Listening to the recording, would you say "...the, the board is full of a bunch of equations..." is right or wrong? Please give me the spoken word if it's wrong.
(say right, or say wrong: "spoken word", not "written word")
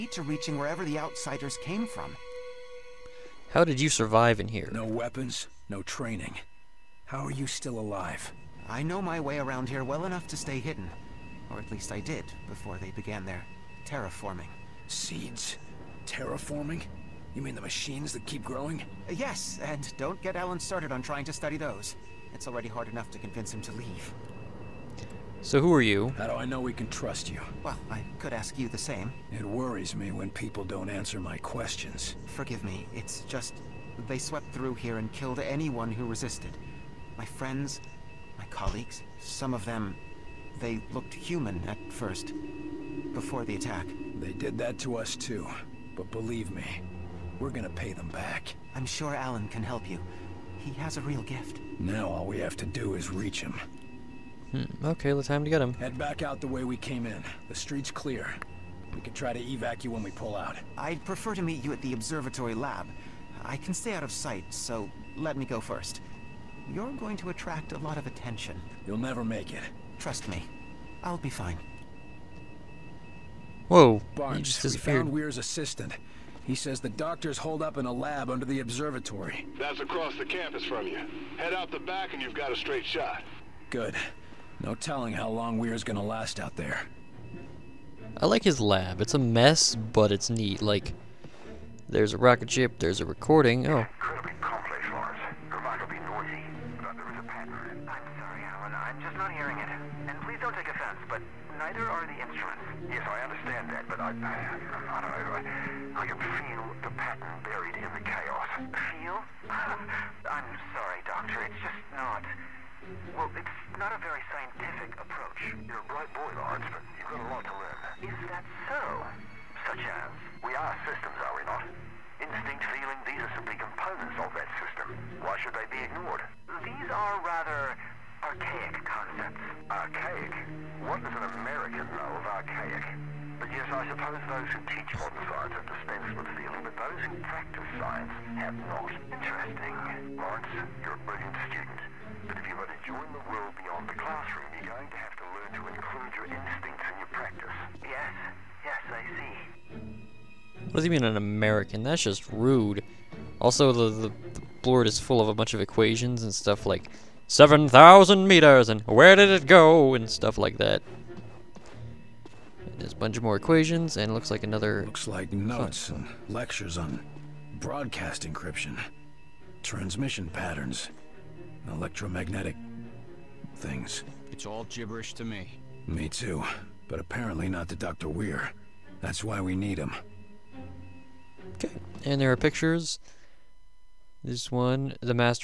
right.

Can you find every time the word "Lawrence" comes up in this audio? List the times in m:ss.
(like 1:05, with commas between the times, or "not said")
1:56, 2:20.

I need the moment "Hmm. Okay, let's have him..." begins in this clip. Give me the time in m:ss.
0:54.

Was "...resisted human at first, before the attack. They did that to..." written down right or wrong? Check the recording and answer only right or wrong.
wrong.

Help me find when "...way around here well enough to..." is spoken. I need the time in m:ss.
0:09.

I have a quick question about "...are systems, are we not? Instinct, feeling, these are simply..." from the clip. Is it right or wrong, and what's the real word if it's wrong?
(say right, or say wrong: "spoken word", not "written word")
right.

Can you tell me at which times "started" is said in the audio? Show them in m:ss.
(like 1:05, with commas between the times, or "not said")
0:20.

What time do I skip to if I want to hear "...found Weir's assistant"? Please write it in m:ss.
1:15.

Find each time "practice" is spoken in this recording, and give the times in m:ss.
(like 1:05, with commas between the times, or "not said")
2:17, 2:27.